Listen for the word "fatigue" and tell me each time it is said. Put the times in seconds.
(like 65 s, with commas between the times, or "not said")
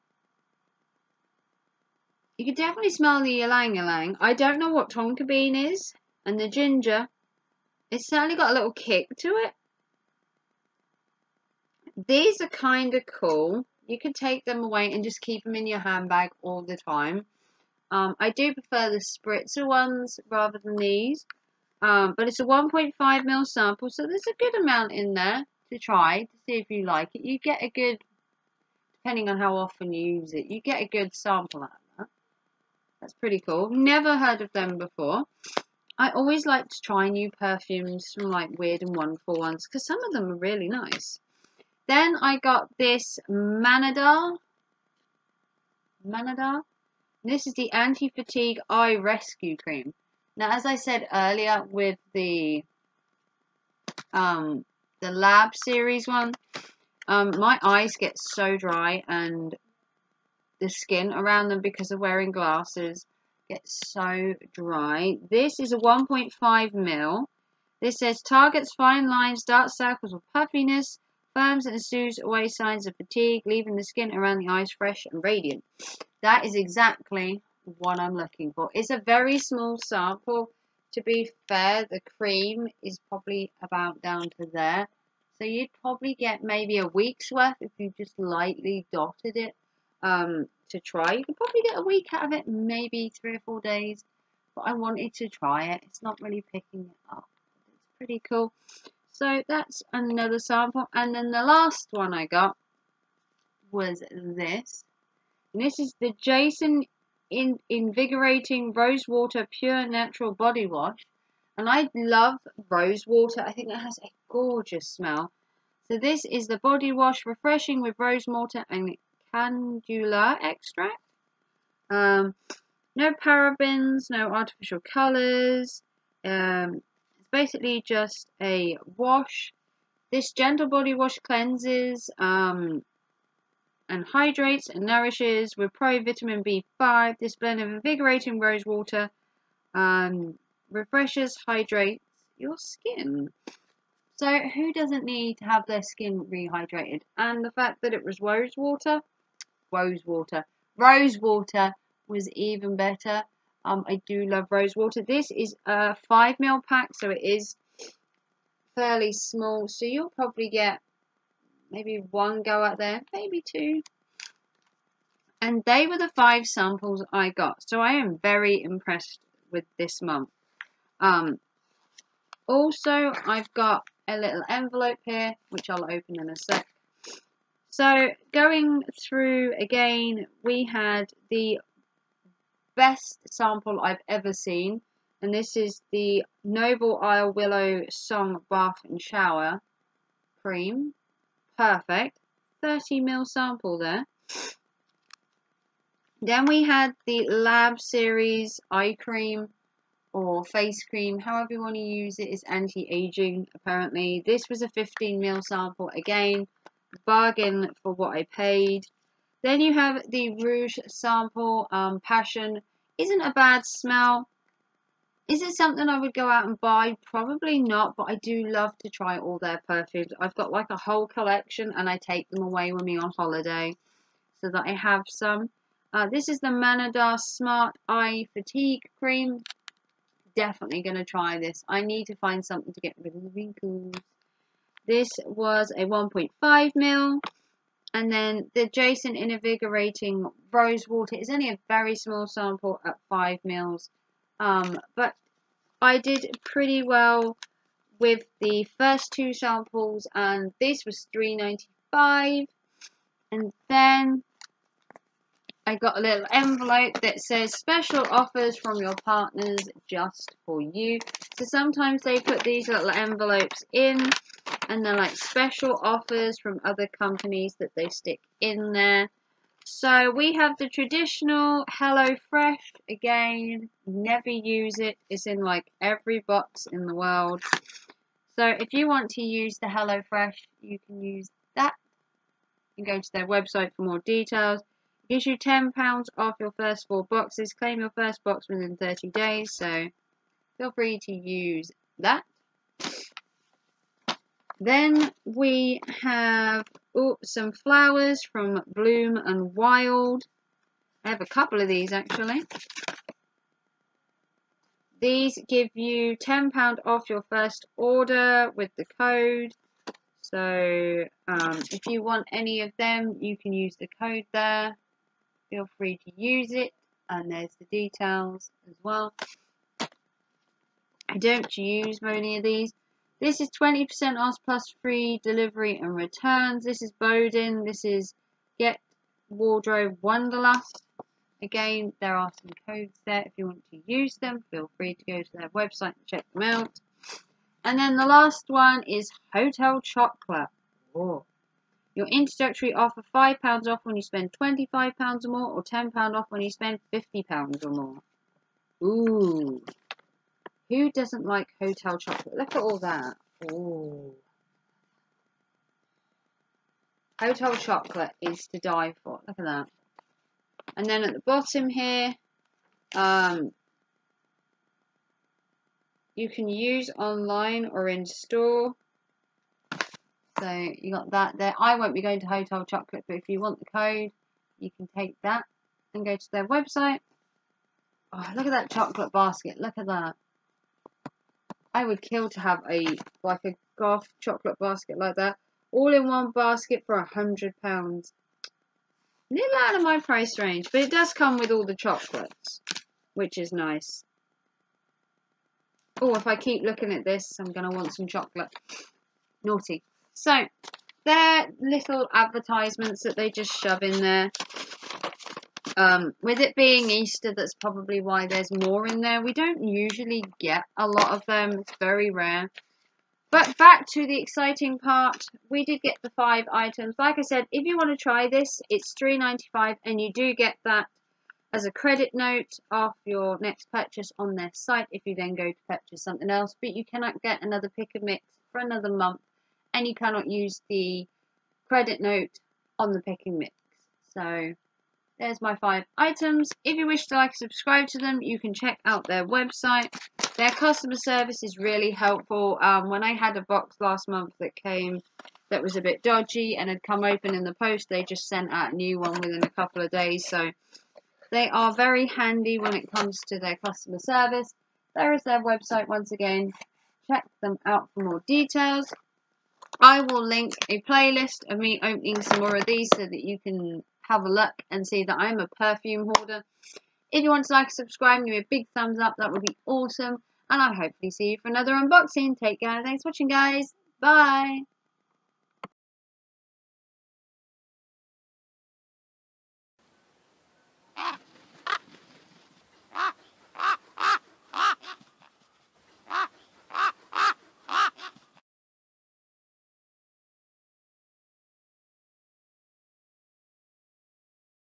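47 s, 72 s, 228 s.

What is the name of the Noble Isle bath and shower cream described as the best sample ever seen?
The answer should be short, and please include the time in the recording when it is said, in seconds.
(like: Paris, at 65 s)
Willow Song, at 187 s.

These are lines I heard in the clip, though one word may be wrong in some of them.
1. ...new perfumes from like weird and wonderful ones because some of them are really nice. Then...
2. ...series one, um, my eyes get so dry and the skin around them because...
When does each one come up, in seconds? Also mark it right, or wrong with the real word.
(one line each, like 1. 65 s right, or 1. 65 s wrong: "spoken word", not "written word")
1. 37 s right
2. 55 s right.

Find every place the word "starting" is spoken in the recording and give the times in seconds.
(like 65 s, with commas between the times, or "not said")
not said.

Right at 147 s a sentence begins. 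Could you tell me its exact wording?
And the fact that it was rose water, rose water, rose water was even better um, I do love rose water.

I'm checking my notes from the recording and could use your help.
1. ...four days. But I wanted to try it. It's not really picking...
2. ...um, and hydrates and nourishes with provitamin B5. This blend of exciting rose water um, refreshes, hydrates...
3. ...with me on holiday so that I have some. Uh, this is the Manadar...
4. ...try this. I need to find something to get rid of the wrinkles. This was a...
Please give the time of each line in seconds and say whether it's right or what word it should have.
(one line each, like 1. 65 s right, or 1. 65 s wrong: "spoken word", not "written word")
1. 93 s right
2. 132 s wrong: "invigorating", not "exciting"
3. 222 s right
4. 231 s right.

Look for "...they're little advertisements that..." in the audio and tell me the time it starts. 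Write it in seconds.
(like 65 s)
401 s.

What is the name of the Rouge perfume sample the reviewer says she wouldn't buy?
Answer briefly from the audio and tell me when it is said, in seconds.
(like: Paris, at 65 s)
Passion, at 211 s.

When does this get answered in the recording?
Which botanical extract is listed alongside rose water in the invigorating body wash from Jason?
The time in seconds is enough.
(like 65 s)
119 s.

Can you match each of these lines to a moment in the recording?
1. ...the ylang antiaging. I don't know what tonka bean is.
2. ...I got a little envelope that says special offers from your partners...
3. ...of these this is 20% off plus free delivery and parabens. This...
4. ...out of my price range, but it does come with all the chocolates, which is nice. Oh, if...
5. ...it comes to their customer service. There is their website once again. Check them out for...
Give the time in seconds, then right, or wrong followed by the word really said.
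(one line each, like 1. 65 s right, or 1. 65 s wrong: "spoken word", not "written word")
1. 3 s wrong: "ylang", not "antiaging"
2. 255 s right
3. 322 s wrong: "returns", not "parabens"
4. 389 s right
5. 452 s right.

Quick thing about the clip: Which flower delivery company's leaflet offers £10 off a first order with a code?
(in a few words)
Bloom and Wild.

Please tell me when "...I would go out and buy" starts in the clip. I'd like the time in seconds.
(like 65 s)
215 s.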